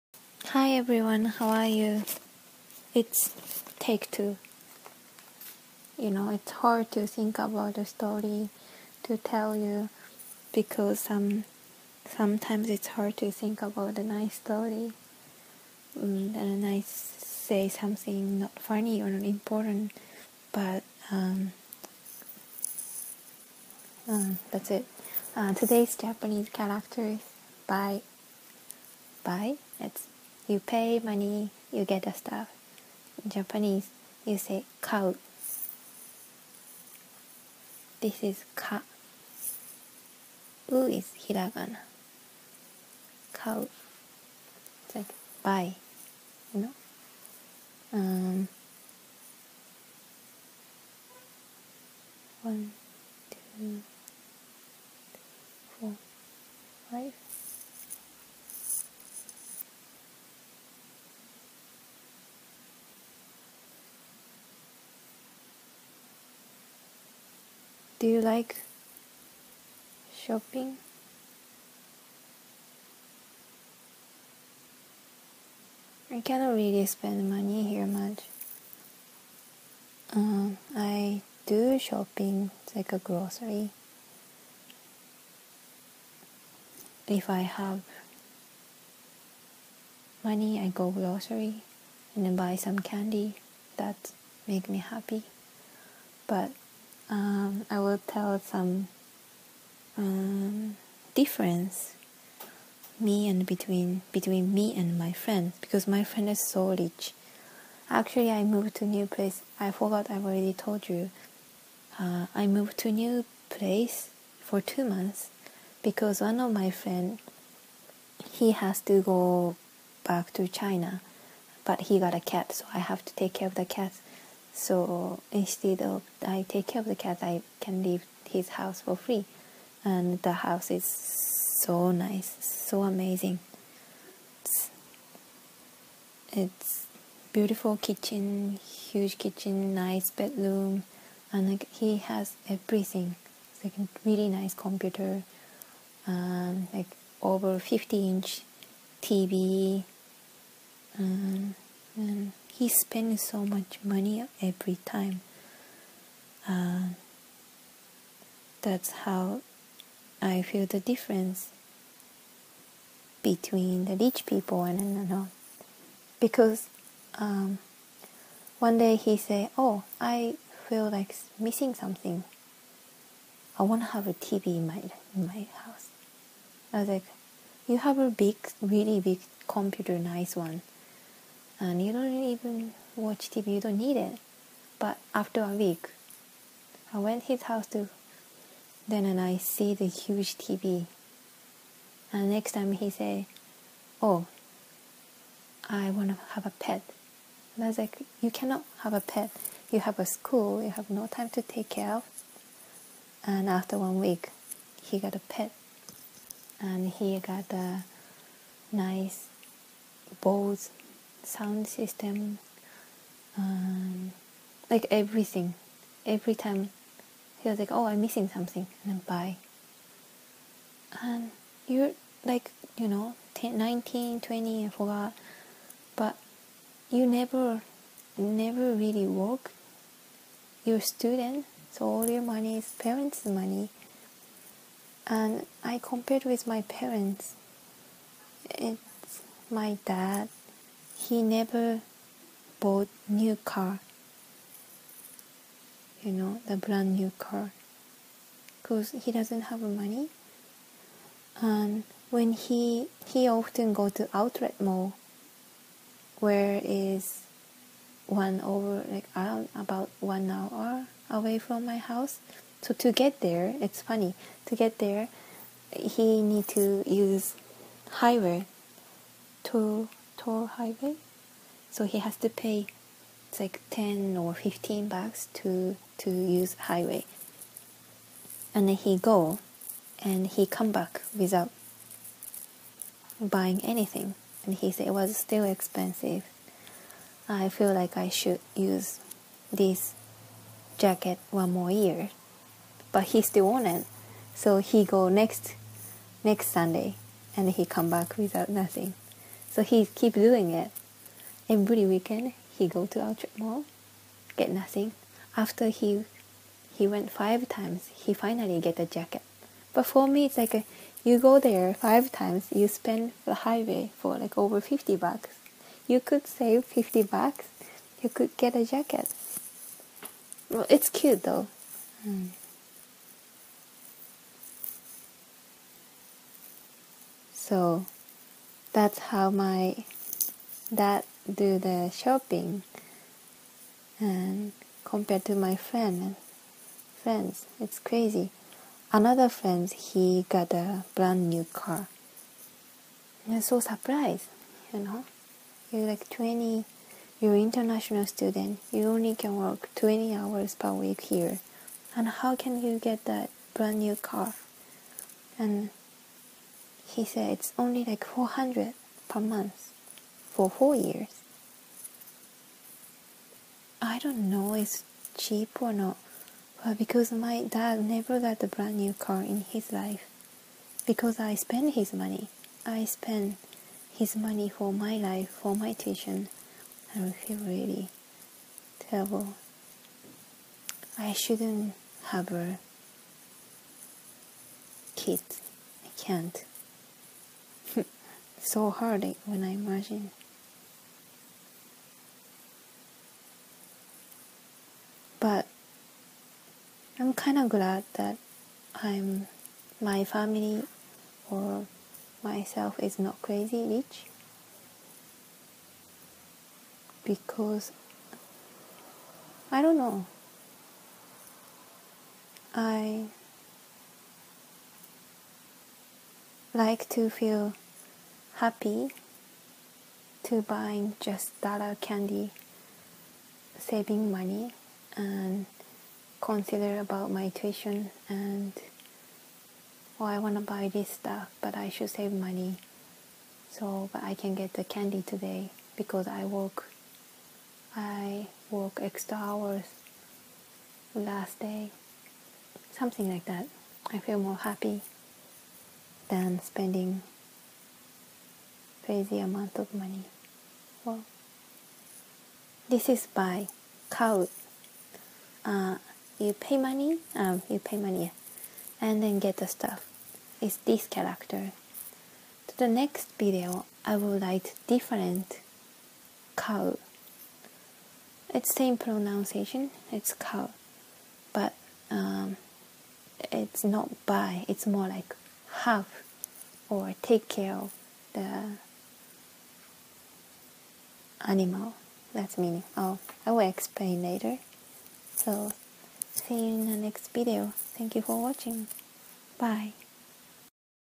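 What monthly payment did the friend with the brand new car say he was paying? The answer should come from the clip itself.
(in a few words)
400.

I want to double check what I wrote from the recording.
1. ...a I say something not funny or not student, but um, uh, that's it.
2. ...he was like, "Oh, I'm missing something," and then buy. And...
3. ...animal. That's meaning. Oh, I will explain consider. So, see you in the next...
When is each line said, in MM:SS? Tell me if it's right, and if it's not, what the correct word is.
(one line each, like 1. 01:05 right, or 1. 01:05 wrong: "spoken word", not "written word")
1. 00:16 wrong: "important", not "student"
2. 03:37 right
3. 08:01 wrong: "later", not "consider".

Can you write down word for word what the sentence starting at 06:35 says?
But I'm kind of glad that I'm my family or myself is not crazy rich because I don't know.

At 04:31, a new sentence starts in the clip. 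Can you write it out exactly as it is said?
So he has to pay it's like 10 or 15 bucks to to use highway.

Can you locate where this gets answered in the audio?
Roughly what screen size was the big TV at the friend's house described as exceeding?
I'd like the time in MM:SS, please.
02:27.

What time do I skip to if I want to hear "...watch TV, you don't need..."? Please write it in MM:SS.
03:02.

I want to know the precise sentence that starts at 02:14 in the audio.
It's, it's beautiful kitchen, huge kitchen, nice bedroom, and like, he has everything.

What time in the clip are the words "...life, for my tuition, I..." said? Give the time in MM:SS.
06:14.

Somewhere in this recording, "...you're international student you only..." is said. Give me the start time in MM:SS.
05:47.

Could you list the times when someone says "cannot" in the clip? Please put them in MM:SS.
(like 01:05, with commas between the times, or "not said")
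01:16, 03:18.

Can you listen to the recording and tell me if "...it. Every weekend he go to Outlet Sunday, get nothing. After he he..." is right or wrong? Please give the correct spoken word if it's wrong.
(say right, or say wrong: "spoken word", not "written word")
wrong: "Mall", not "Sunday".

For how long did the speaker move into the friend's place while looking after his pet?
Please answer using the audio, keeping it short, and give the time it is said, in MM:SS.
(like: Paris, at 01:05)
two months, at 01:54.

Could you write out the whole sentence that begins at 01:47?
Actually, I moved to new place.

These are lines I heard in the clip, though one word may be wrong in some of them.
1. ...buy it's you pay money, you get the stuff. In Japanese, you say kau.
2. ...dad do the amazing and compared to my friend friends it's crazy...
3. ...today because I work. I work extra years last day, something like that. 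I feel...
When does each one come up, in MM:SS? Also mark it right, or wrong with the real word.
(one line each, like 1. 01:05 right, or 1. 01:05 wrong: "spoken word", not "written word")
1. 00:29 right
2. 05:30 wrong: "shopping", not "amazing"
3. 07:15 wrong: "hours", not "years".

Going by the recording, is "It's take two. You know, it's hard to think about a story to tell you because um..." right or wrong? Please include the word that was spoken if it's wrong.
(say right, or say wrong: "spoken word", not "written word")
right.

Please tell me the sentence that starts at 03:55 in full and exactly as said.
And I compared with my parents.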